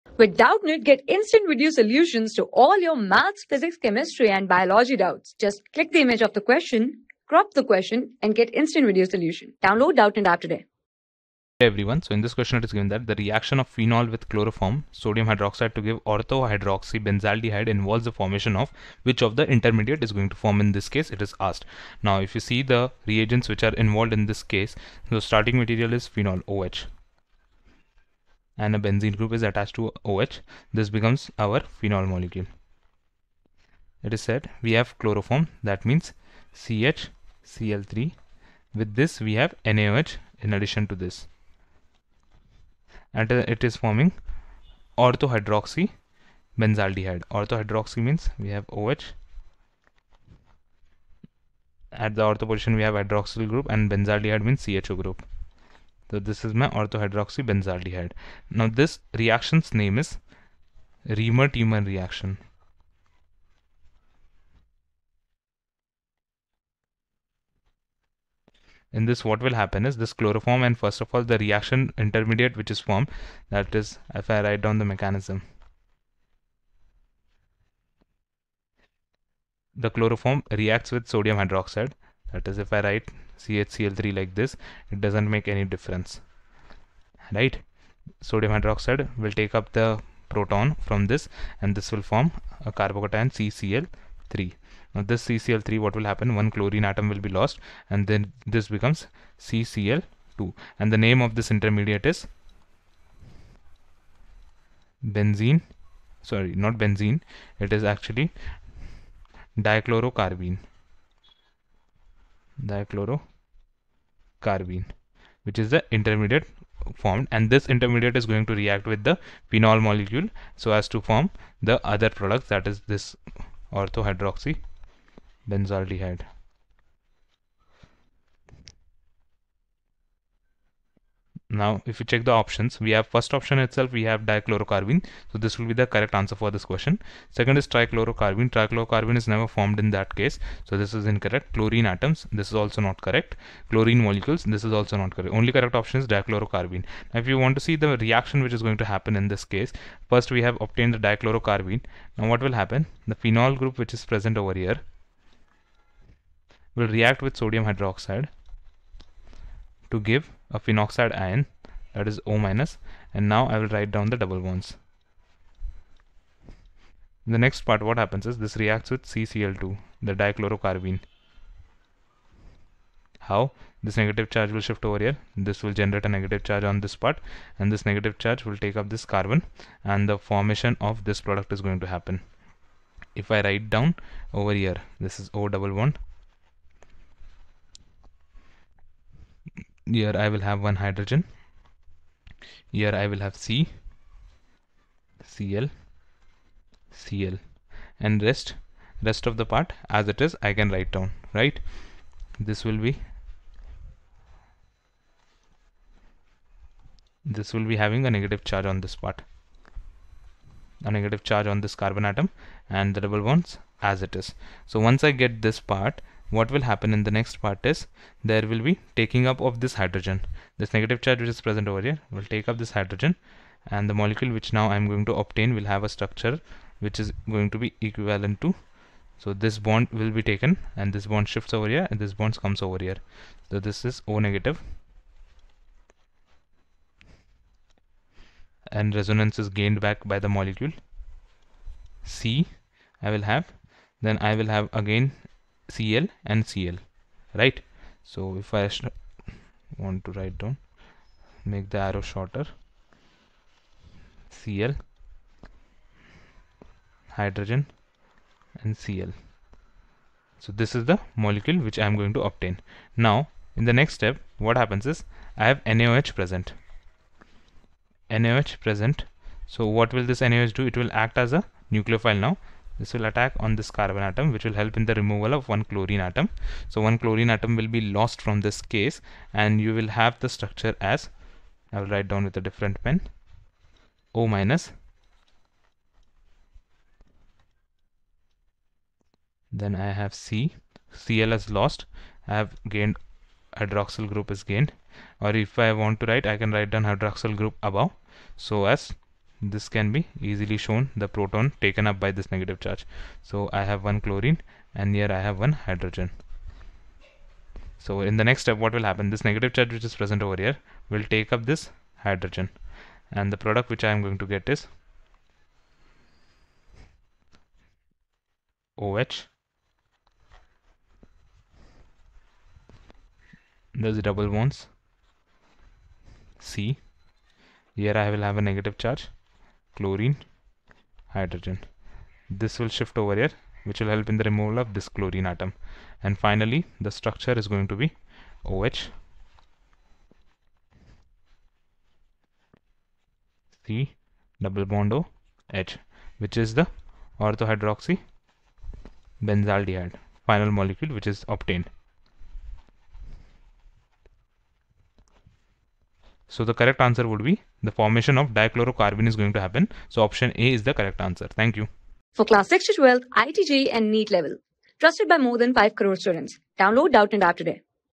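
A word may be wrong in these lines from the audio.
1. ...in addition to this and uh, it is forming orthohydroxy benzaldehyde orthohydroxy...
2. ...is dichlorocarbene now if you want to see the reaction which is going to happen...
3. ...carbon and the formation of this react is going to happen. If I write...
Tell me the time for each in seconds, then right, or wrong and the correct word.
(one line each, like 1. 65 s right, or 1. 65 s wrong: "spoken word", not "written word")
1. 40 s right
2. 145 s right
3. 179 s wrong: "product", not "react".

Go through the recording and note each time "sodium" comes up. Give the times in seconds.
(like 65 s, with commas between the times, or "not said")
14 s, 81 s, 88 s, 157 s.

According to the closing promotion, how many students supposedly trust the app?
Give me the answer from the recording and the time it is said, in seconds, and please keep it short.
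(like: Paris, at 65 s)
more than 5 crore, at 365 s.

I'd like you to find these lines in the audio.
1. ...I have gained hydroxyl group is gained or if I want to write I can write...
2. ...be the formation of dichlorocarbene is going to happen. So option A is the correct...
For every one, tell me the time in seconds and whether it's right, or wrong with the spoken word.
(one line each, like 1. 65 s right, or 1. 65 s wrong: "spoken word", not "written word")
1. 292 s right
2. 357 s right.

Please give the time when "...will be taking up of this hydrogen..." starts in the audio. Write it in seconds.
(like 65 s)
218 s.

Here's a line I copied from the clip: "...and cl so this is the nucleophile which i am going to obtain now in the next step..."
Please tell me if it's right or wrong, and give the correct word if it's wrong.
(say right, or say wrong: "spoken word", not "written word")
wrong: "molecule", not "nucleophile".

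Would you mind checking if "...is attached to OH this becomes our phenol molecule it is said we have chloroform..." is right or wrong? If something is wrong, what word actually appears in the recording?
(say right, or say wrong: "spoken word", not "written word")
right.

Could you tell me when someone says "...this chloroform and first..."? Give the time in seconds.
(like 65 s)
69 s.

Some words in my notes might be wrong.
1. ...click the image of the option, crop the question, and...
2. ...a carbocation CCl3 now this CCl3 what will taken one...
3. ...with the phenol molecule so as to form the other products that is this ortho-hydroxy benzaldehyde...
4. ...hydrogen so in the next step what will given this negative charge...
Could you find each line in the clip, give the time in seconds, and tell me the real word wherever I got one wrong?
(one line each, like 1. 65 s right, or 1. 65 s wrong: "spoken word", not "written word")
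1. 5 s wrong: "question", not "option"
2. 92 s wrong: "happen", not "taken"
3. 118 s right
4. 305 s wrong: "happen", not "given".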